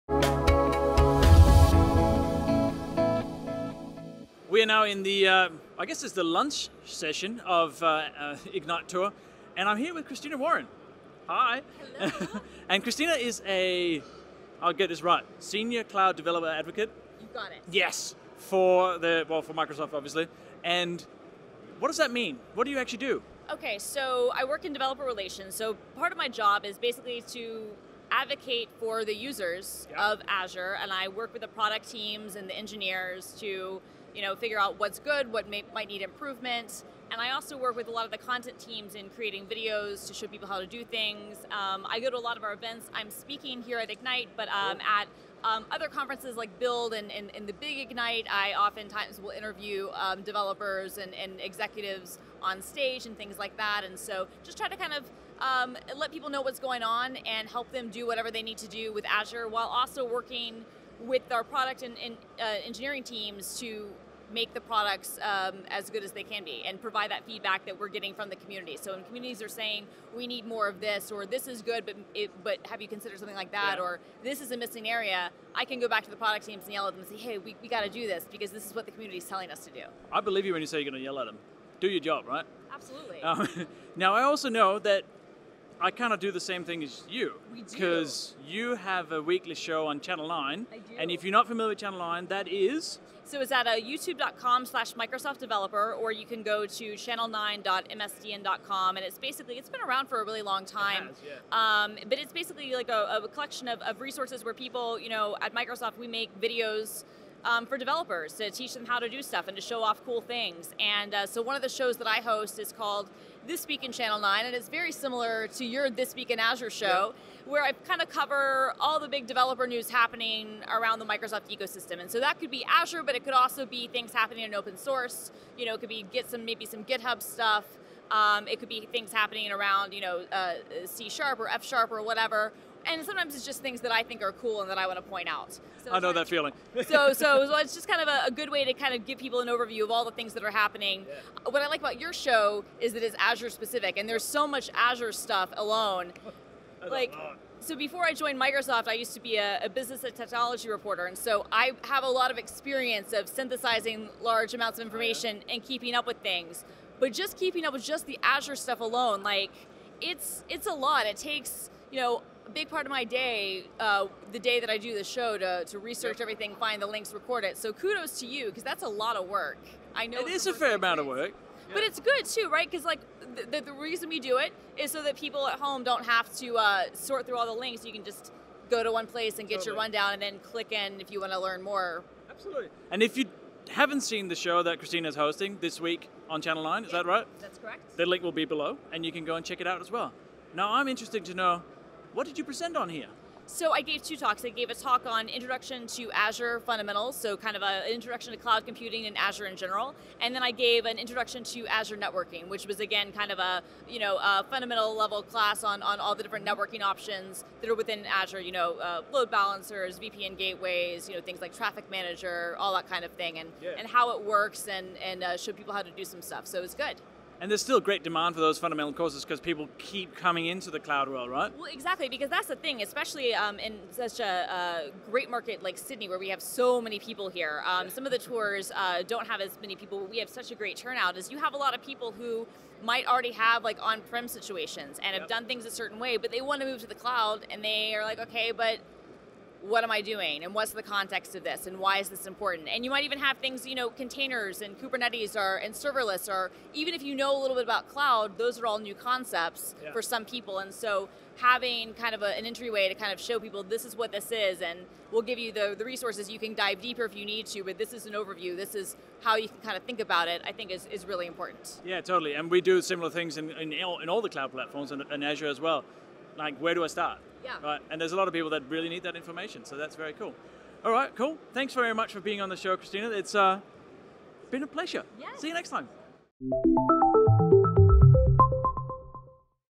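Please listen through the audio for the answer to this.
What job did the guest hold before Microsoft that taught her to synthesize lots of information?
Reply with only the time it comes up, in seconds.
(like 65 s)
149 s.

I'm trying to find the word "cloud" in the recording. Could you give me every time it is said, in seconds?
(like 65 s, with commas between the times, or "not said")
15 s, 198 s, 220 s, 236 s, 247 s, 264 s.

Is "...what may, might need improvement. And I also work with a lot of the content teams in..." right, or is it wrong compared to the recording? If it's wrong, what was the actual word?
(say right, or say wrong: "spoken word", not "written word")
right.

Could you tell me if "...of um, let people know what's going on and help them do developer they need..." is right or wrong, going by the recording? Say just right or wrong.
wrong.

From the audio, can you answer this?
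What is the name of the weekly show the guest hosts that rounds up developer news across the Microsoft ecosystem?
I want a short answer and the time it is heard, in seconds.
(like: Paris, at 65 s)
This Week in Channel 9, at 113 s.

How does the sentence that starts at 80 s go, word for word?
I believe you when you say you're going to yell at them.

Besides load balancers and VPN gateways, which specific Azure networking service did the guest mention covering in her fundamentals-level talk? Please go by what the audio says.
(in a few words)
Traffic Manager.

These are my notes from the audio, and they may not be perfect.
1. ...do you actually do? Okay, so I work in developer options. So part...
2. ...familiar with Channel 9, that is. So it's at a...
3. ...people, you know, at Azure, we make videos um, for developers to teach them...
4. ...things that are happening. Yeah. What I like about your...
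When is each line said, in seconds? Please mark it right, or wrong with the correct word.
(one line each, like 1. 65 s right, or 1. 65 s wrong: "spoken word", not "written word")
1. 22 s wrong: "relations", not "options"
2. 91 s right
3. 104 s wrong: "Microsoft", not "Azure"
4. 140 s right.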